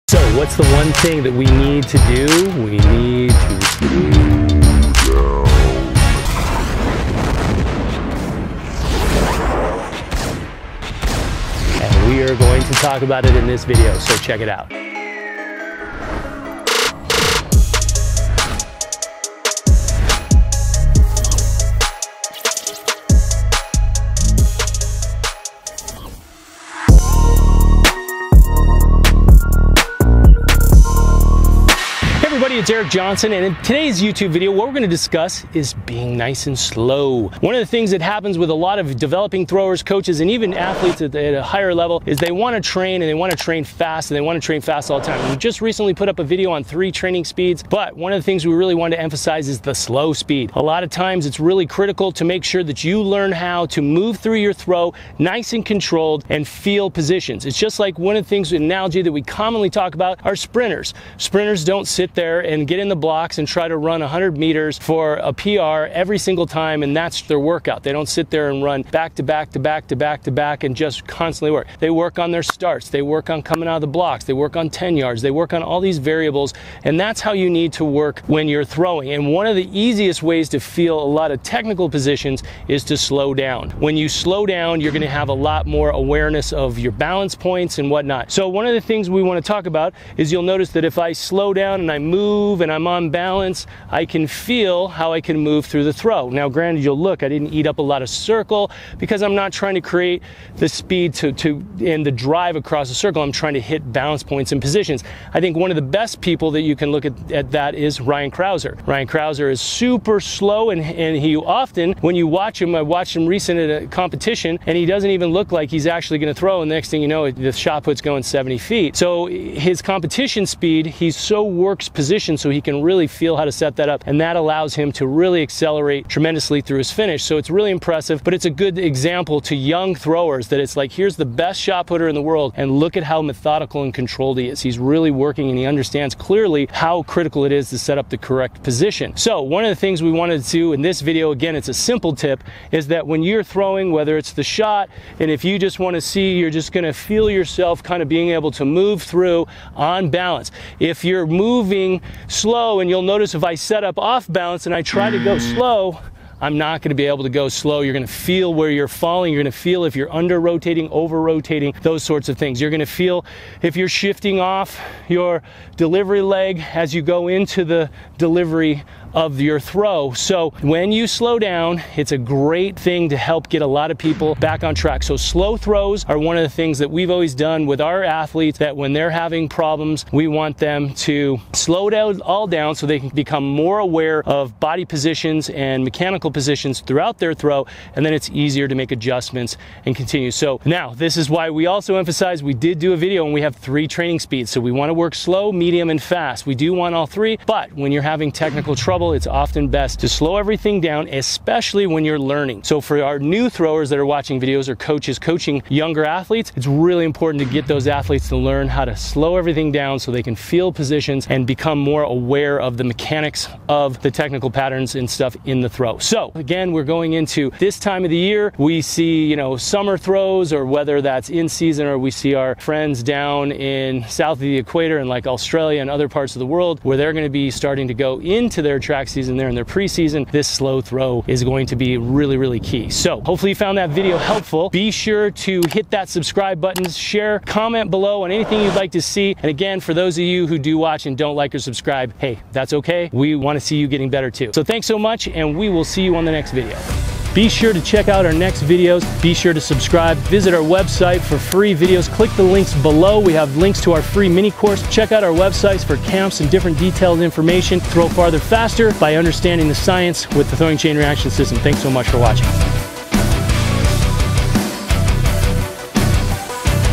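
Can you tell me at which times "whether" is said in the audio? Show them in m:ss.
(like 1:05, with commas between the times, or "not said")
2:23, 3:40.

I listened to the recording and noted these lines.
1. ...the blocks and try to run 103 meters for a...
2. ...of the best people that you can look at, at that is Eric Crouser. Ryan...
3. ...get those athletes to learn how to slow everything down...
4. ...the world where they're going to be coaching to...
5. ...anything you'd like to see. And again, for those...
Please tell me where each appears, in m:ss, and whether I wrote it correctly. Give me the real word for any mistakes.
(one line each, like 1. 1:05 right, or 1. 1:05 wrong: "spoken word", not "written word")
1. 1:02 wrong: "100", not "103"
2. 1:45 wrong: "Ryan", not "Eric"
3. 3:27 right
4. 3:46 wrong: "starting", not "coaching"
5. 3:58 right.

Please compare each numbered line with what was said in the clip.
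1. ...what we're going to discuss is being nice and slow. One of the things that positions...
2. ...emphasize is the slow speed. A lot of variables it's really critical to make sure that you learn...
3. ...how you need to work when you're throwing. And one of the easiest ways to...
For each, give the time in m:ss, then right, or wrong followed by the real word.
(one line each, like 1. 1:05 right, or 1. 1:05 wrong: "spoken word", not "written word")
1. 0:34 wrong: "happens", not "positions"
2. 0:49 wrong: "times", not "variables"
3. 1:17 right.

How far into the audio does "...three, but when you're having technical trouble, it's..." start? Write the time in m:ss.
3:17.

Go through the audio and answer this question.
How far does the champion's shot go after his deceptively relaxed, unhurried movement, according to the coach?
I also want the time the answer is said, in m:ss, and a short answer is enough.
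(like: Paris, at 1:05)
70 feet, at 1:58.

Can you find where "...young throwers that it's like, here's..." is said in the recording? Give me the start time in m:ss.
2:09.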